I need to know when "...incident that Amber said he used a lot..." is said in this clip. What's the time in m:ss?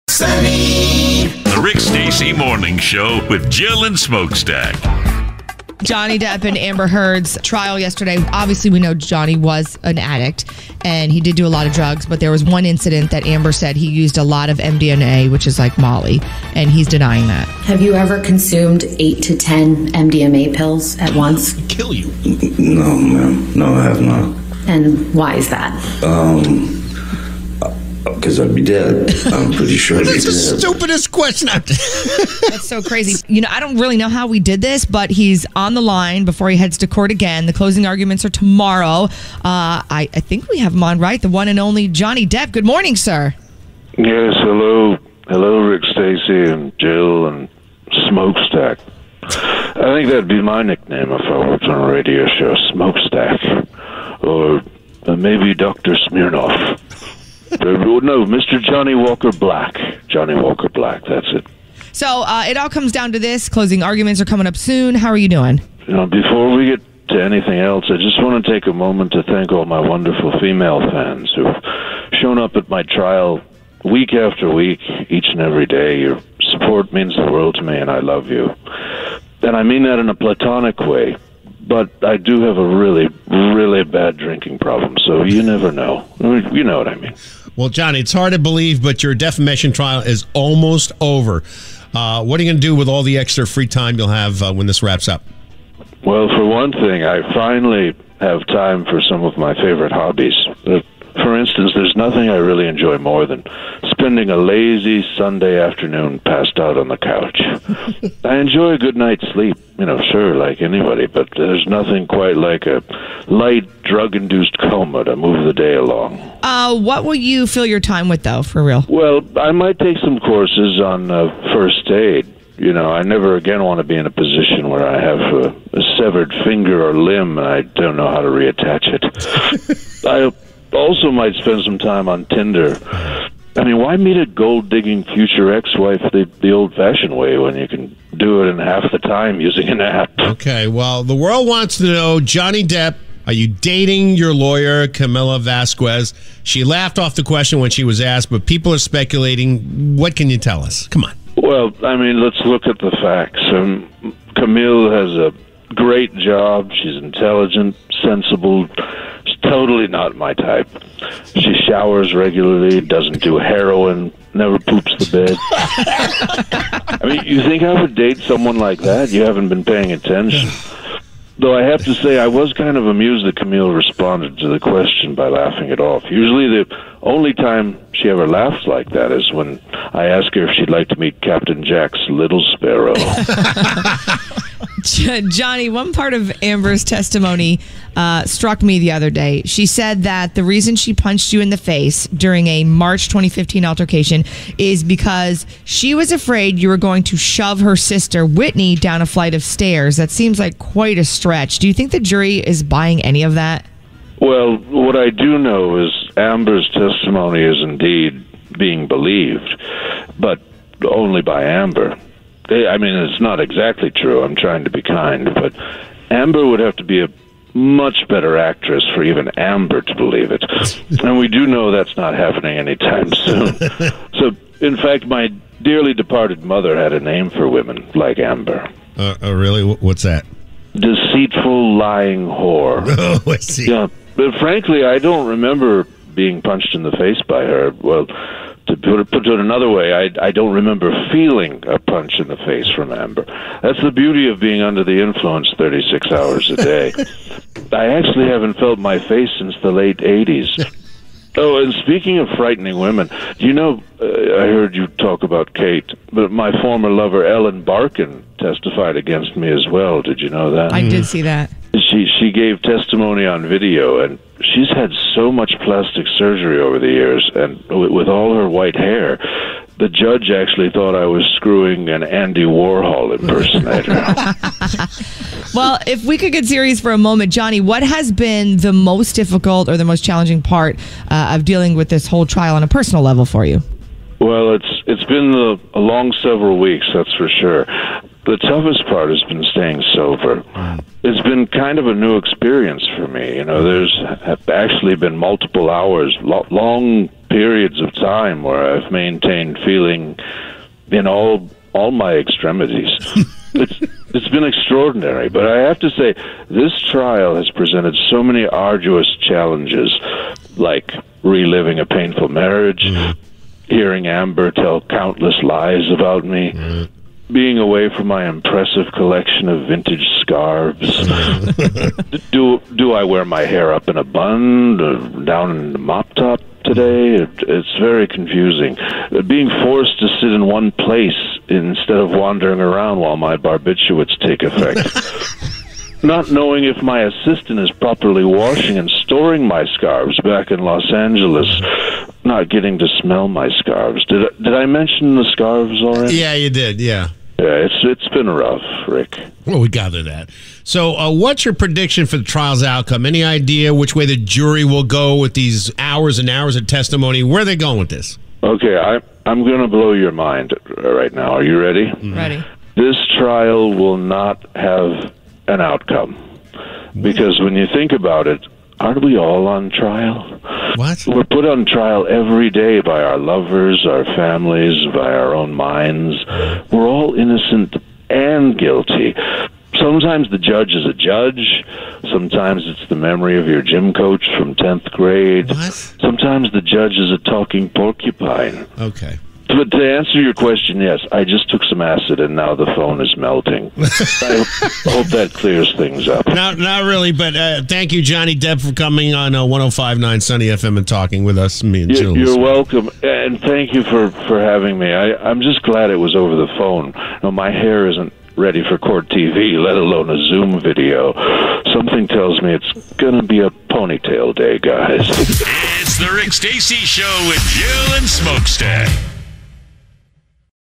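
0:12.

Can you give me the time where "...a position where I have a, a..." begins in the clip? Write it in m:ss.
2:04.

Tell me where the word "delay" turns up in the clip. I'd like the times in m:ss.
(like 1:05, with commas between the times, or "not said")
not said.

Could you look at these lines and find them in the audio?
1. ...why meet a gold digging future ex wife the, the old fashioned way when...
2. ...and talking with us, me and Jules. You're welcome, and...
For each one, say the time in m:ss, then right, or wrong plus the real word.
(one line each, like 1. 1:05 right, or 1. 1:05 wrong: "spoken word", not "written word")
1. 2:13 right
2. 6:40 right.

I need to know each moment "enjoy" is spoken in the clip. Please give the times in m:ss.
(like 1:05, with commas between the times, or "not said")
1:42, 1:48.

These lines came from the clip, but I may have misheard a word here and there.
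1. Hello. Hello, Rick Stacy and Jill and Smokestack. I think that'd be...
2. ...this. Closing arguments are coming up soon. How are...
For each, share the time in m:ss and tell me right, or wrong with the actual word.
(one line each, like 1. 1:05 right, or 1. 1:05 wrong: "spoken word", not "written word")
1. 0:44 right
2. 1:03 right.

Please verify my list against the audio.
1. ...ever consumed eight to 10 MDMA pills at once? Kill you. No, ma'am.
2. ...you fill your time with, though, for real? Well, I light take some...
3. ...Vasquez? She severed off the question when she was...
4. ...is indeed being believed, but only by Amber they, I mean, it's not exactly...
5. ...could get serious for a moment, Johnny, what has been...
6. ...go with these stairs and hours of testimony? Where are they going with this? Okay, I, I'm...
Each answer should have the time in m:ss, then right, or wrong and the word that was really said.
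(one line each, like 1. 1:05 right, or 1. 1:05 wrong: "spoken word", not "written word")
1. 0:17 right
2. 1:57 wrong: "might", not "light"
3. 2:25 wrong: "laughed", not "severed"
4. 3:27 right
5. 4:36 right
6. 5:54 wrong: "hours", not "stairs".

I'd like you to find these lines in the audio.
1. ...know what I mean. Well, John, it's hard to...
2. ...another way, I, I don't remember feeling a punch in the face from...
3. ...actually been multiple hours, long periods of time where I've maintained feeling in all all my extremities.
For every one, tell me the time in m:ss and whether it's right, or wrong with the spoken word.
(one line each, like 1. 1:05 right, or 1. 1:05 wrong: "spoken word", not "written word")
1. 1:26 right
2. 3:59 right
3. 4:54 right.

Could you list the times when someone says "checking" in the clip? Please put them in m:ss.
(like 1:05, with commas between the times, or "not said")
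not said.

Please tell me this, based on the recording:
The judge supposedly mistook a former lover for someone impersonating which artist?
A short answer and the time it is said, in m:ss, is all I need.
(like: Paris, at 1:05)
Andy Warhol, at 4:32.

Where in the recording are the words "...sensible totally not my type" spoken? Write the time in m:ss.
2:38.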